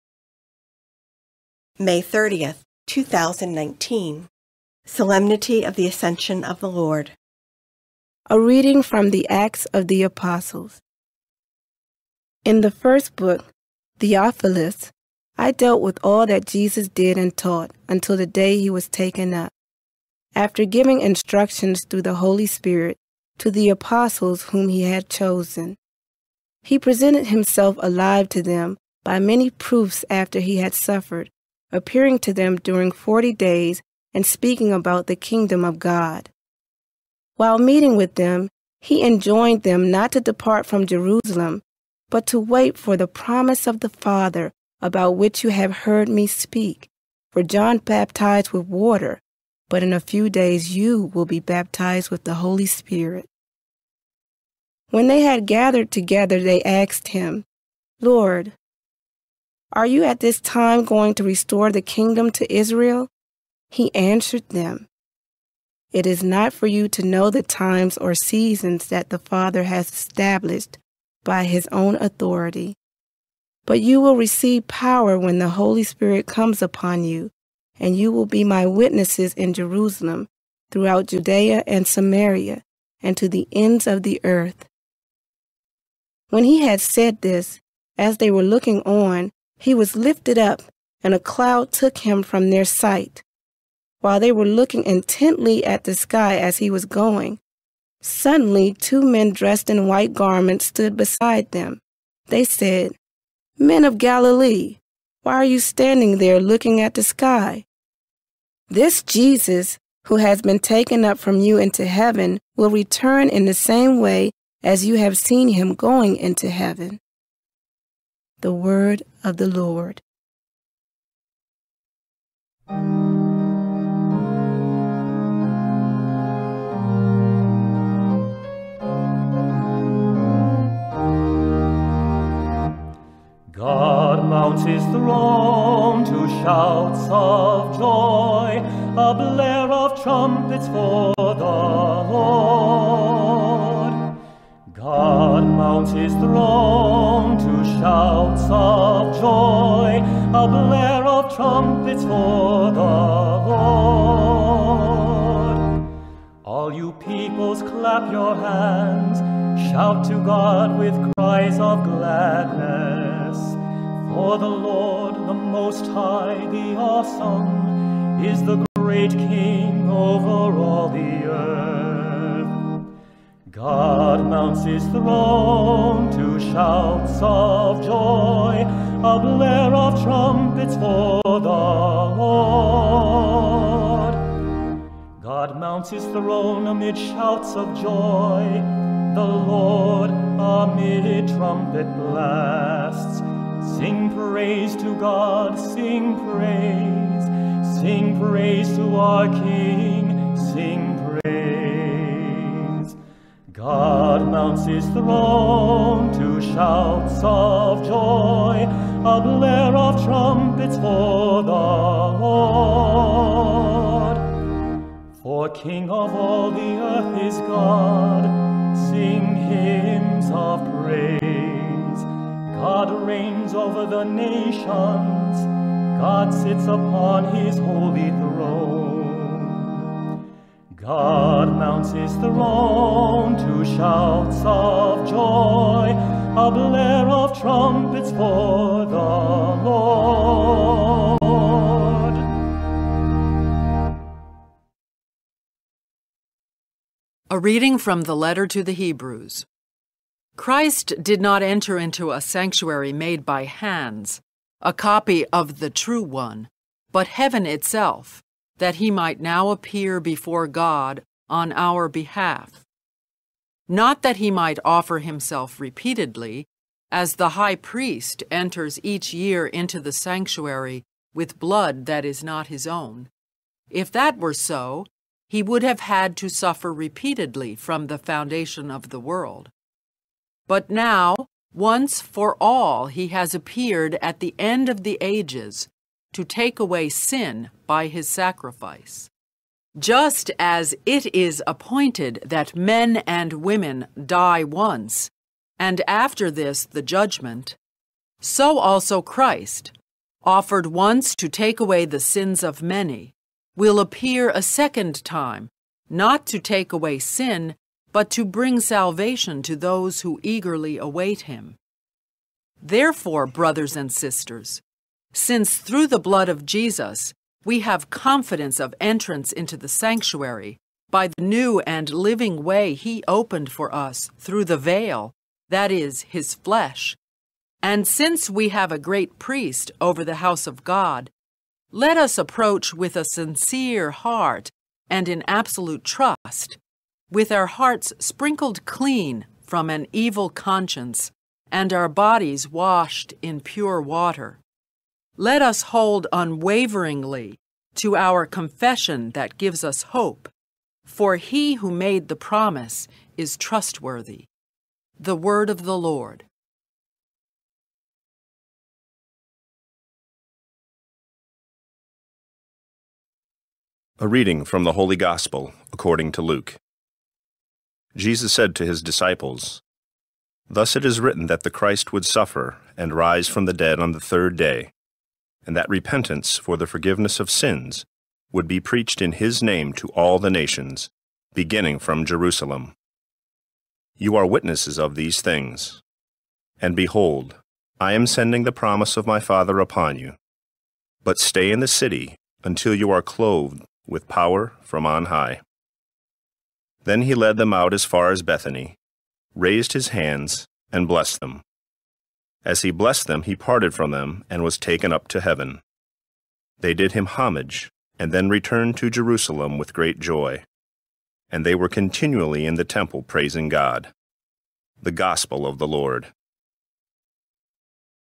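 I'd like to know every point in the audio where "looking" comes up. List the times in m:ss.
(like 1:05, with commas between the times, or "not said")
1:28, 1:34, 1:46.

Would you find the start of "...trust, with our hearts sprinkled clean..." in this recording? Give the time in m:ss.
5:35.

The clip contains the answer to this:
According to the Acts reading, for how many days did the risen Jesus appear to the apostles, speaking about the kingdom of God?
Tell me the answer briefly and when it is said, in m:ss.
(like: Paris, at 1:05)
40, at 0:32.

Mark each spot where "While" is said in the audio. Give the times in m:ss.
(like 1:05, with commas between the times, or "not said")
0:37, 1:33.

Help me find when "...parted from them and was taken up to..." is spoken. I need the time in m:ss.
6:43.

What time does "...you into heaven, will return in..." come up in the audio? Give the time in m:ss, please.
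1:51.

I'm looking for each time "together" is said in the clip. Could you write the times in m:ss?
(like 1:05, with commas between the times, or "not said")
0:55.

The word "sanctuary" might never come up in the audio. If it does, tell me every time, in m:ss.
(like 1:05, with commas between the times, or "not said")
4:12, 4:29, 5:19.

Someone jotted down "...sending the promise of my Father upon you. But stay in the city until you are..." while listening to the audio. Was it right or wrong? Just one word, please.
right.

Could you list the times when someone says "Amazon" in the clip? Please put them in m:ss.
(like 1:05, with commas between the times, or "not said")
not said.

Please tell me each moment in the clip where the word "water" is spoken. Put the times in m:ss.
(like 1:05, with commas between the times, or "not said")
0:48, 5:43.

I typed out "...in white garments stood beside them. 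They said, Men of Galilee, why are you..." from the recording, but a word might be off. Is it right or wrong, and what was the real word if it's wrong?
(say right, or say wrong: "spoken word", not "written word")
right.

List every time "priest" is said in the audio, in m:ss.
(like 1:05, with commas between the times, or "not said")
4:27, 5:29.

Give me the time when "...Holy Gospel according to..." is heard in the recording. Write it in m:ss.
6:04.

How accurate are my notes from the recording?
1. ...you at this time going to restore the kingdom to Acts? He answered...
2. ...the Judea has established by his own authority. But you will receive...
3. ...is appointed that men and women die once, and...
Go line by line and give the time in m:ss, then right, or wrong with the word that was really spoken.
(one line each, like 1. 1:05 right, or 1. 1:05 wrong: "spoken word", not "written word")
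1. 0:59 wrong: "Israel", not "Acts"
2. 1:09 wrong: "Father", not "Judea"
3. 4:51 right.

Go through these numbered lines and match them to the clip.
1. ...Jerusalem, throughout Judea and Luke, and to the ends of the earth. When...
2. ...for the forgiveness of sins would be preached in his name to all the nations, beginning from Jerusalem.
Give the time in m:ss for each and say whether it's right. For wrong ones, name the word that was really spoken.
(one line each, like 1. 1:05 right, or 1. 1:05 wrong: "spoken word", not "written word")
1. 1:19 wrong: "Samaria", not "Luke"
2. 6:16 right.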